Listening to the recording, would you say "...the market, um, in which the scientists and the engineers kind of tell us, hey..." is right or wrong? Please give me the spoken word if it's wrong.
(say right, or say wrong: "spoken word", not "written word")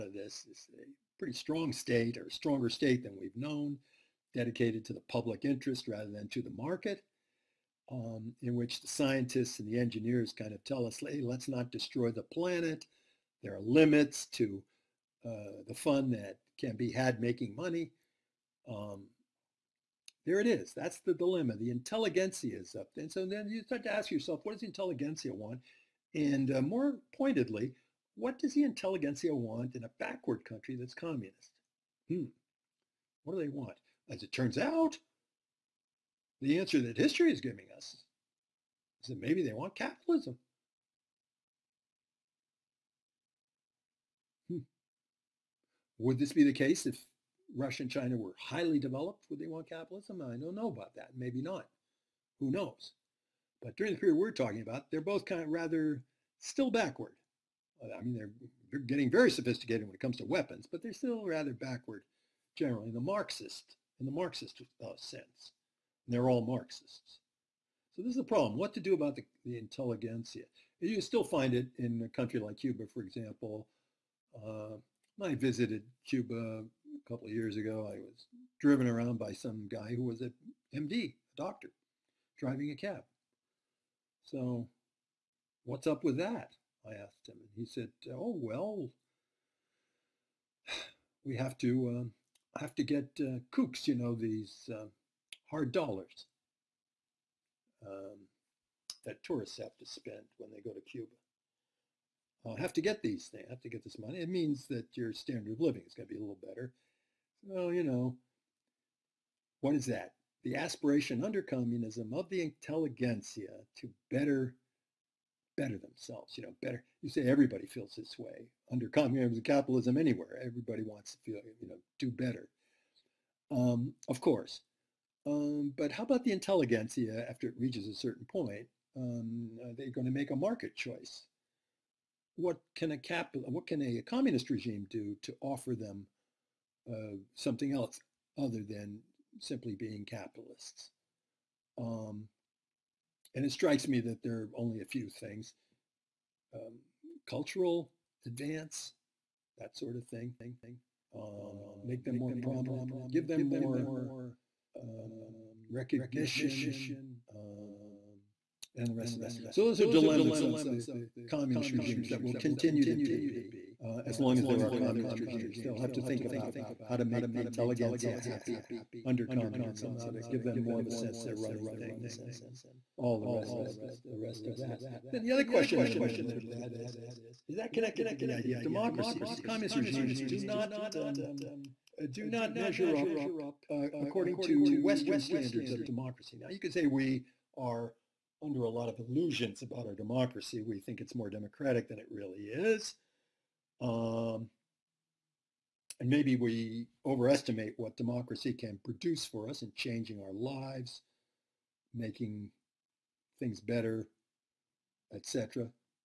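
right.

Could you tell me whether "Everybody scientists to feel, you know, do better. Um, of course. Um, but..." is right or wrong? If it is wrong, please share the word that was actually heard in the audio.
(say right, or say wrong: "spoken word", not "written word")
wrong: "wants", not "scientists".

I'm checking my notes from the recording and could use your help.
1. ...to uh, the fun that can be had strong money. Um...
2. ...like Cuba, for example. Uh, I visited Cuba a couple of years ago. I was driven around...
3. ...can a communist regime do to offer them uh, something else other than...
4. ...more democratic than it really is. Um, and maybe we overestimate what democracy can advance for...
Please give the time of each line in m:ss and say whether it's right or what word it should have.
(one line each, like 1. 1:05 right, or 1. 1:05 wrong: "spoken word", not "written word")
1. 0:14 wrong: "making", not "strong"
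2. 1:12 right
3. 2:13 right
4. 3:11 wrong: "produce", not "advance".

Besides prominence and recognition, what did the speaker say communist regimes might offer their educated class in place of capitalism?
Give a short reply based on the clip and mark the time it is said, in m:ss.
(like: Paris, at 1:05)
Cultural advance, at 2:27.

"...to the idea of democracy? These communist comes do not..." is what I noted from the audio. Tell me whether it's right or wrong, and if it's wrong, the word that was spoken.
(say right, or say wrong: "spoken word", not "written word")
wrong: "regimes", not "comes".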